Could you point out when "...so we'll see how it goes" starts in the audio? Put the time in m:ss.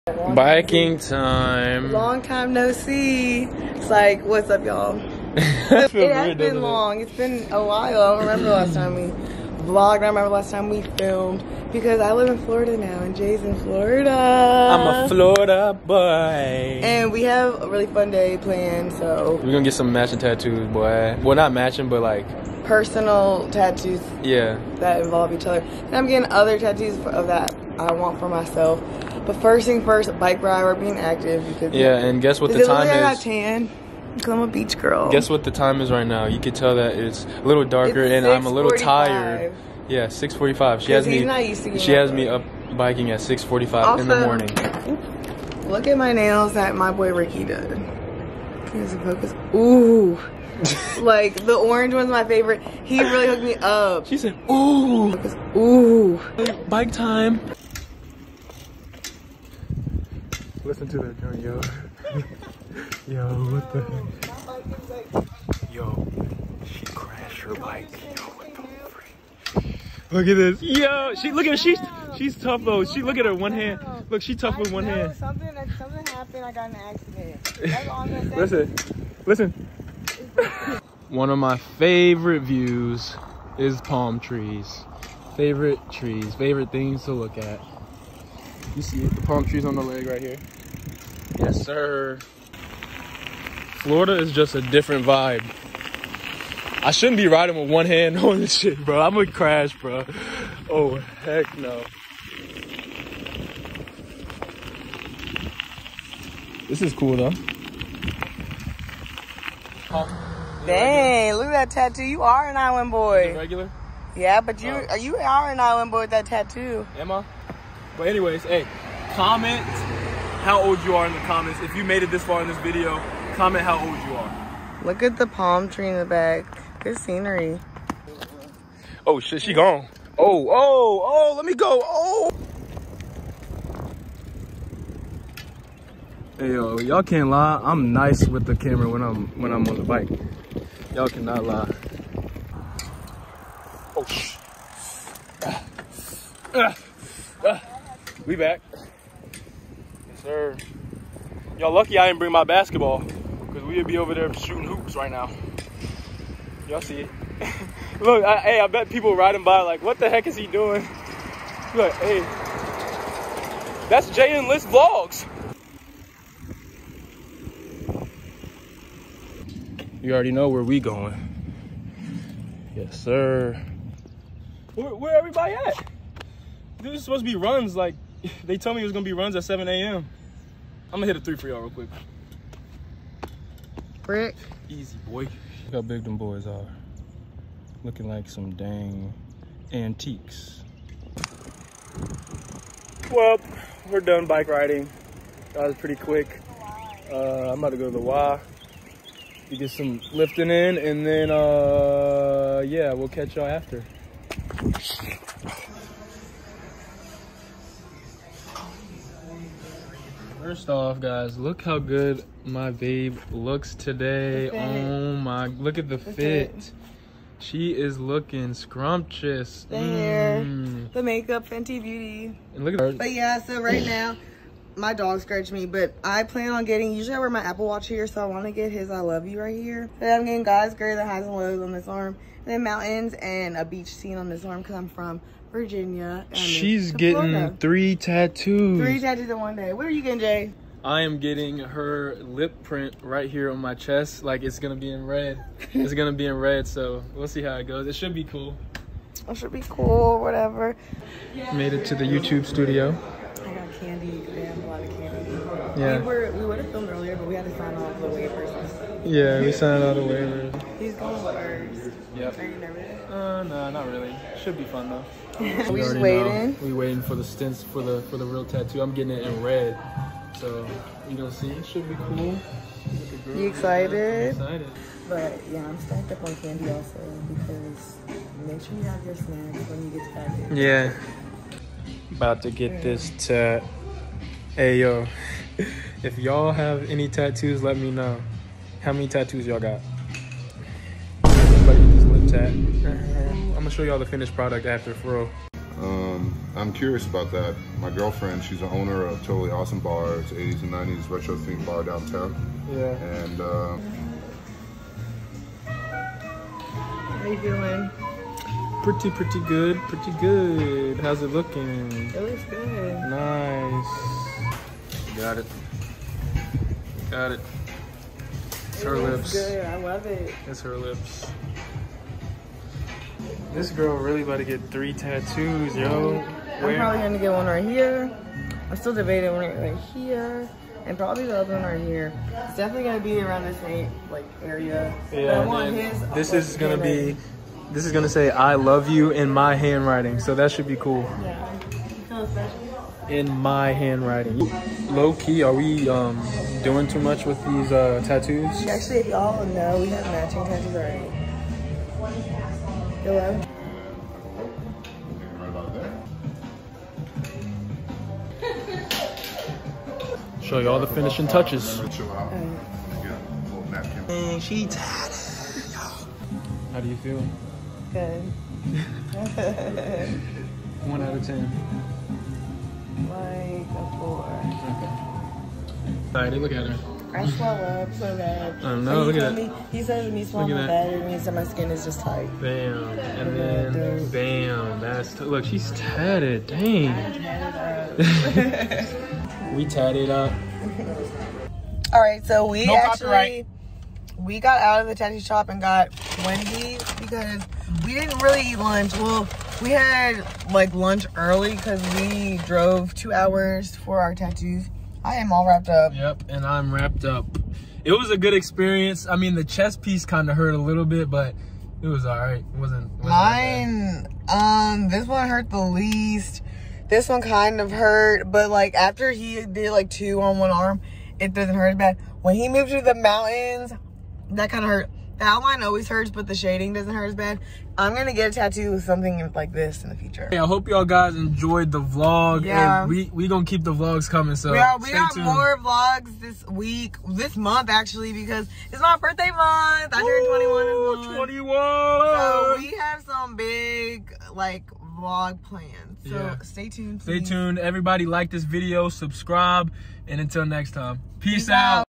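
4:06.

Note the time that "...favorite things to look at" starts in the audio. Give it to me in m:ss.
1:26.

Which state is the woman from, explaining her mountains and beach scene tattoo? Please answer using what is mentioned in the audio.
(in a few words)
Virginia.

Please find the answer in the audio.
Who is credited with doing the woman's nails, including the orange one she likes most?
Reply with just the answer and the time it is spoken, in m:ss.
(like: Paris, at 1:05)
Ricky, at 0:46.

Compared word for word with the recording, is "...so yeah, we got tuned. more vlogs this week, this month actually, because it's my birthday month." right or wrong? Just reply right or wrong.
right.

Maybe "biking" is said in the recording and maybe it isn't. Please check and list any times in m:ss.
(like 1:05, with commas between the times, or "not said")
0:00, 0:42.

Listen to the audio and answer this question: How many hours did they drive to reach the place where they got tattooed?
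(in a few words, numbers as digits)
2.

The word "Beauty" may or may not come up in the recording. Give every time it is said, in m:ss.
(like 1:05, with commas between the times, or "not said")
3:41.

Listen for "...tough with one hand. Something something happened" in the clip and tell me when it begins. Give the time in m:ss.
1:14.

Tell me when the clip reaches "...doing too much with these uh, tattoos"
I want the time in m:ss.
5:46.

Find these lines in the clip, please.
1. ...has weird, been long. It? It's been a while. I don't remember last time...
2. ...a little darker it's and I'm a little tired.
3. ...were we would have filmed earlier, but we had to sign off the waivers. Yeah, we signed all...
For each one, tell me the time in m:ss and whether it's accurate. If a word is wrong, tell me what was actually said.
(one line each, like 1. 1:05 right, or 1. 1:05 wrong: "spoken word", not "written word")
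1. 0:05 right
2. 0:37 right
3. 4:16 right.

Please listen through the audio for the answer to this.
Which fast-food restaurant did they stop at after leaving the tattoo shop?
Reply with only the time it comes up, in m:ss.
6:36.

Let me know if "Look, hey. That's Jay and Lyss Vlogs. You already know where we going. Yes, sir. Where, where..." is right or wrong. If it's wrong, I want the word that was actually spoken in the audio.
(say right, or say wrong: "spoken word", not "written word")
right.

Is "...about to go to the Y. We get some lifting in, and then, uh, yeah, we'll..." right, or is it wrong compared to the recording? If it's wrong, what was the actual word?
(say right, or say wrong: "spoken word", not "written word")
right.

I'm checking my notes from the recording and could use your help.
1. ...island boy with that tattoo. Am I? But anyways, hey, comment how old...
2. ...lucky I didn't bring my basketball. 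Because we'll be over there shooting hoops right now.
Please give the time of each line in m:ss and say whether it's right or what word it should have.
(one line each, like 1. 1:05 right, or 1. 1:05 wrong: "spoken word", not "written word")
1. 1:55 right
2. 2:31 right.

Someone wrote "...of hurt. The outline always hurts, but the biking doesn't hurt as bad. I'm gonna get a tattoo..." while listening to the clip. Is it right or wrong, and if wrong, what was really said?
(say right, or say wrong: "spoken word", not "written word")
wrong: "shading", not "biking".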